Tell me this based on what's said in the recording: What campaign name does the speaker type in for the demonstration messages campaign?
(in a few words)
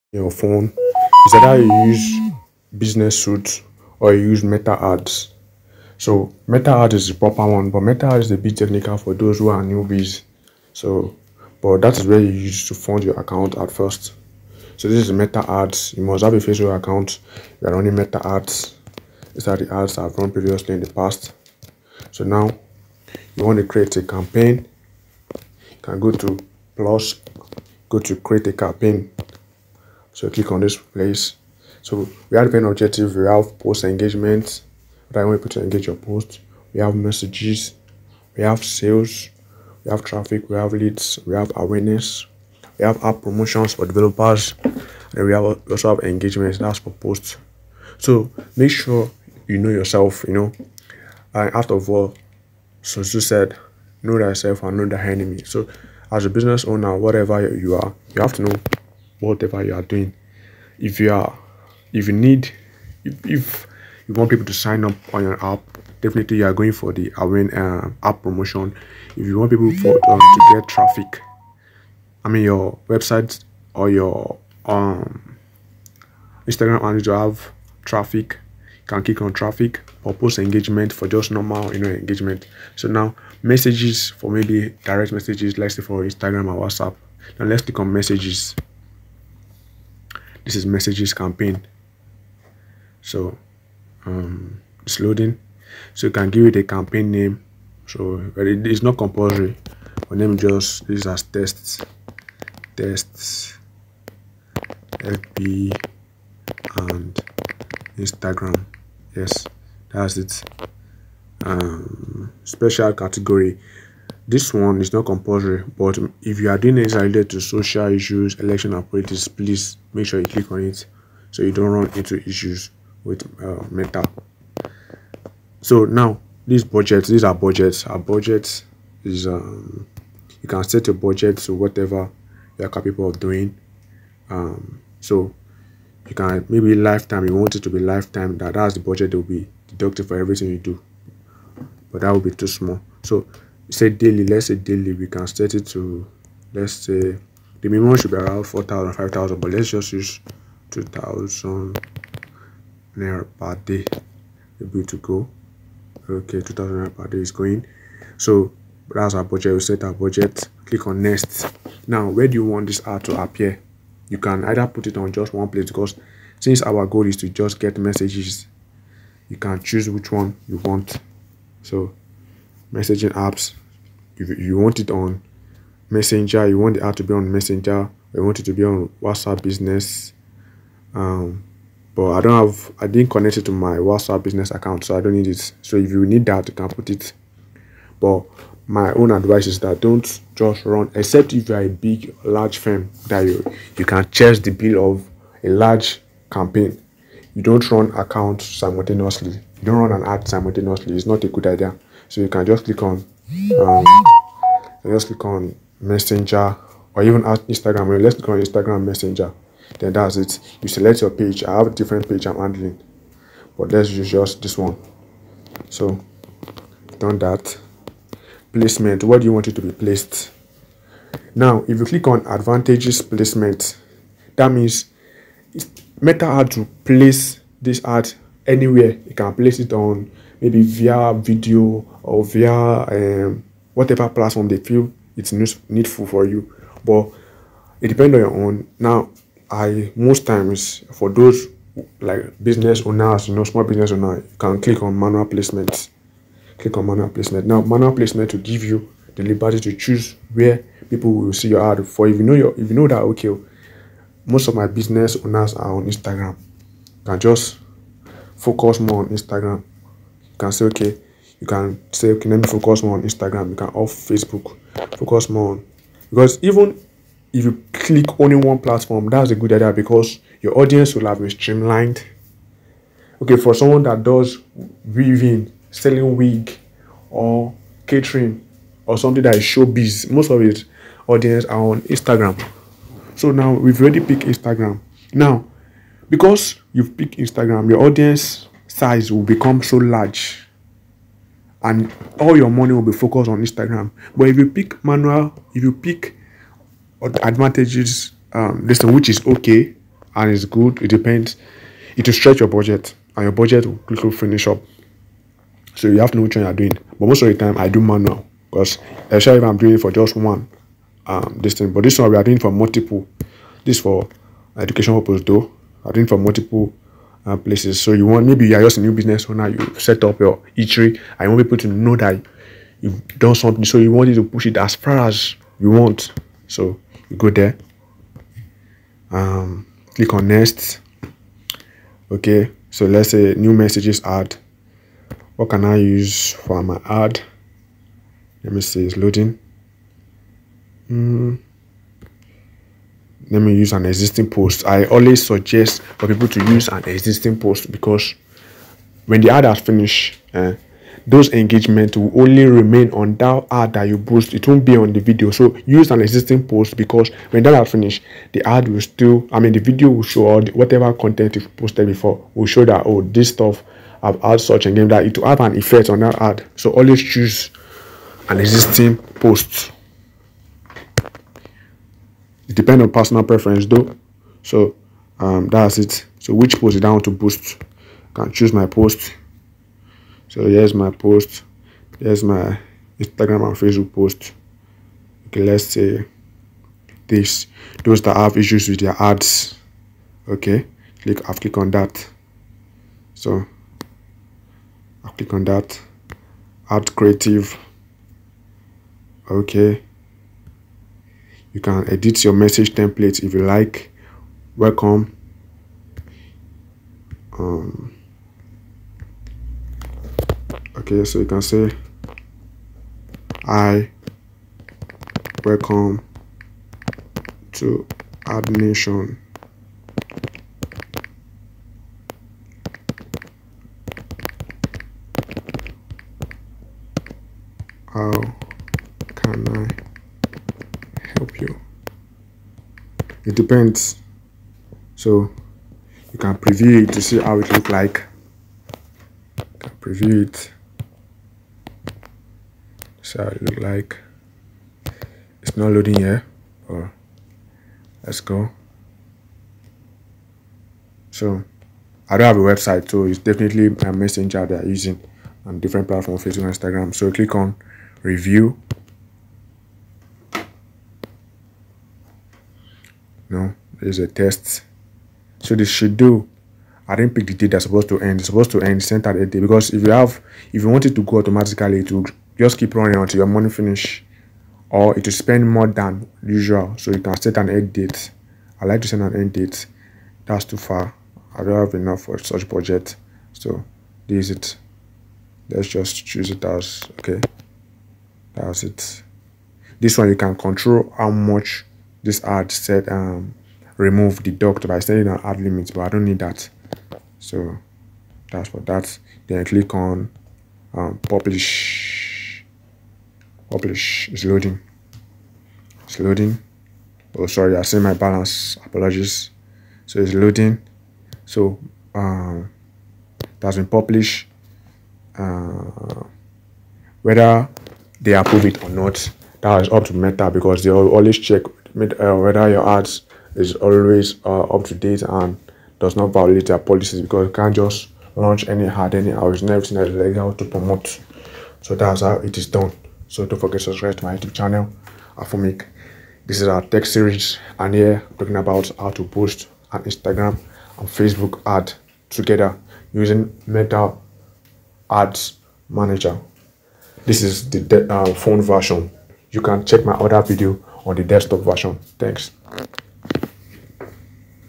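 tests FB and Instagram.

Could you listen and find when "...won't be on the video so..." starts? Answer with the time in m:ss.
5:54.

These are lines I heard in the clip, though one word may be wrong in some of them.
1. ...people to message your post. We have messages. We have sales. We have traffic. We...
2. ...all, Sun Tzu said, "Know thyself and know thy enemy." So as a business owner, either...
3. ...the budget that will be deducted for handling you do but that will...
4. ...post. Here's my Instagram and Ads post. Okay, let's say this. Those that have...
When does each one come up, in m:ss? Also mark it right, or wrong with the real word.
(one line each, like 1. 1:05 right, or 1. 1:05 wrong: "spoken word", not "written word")
1. 0:35 wrong: "engage", not "message"
2. 0:51 wrong: "whatever", not "either"
3. 2:18 wrong: "everything", not "handling"
4. 6:20 wrong: "Facebook", not "Ads".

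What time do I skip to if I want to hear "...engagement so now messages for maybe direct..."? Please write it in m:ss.
1:21.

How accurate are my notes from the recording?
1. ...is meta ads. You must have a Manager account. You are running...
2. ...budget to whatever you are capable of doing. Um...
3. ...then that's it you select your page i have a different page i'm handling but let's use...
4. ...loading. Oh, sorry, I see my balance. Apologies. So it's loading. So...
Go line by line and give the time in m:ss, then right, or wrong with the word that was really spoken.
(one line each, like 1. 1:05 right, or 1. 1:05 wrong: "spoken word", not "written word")
1. 0:15 wrong: "Facebook", not "Manager"
2. 2:10 right
3. 3:29 right
4. 8:25 right.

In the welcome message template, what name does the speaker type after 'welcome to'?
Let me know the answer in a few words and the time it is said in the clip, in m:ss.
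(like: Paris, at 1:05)
AdNation, at 6:58.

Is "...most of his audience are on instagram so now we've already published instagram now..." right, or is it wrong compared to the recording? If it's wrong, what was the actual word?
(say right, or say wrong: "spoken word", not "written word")
wrong: "picked", not "published".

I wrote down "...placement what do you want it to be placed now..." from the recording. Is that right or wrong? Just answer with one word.
right.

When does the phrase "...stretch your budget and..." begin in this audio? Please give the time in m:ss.
5:02.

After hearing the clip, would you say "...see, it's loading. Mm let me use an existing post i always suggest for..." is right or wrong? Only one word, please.
right.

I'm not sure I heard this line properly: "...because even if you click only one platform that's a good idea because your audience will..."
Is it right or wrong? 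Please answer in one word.
right.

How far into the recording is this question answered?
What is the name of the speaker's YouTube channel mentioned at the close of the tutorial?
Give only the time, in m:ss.
8:55.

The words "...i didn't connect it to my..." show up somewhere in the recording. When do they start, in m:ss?
3:02.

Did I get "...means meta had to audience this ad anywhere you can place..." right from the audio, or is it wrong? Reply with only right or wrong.
wrong.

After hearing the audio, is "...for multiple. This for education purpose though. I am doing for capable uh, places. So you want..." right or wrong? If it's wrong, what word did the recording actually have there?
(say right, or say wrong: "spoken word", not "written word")
wrong: "multiple", not "capable".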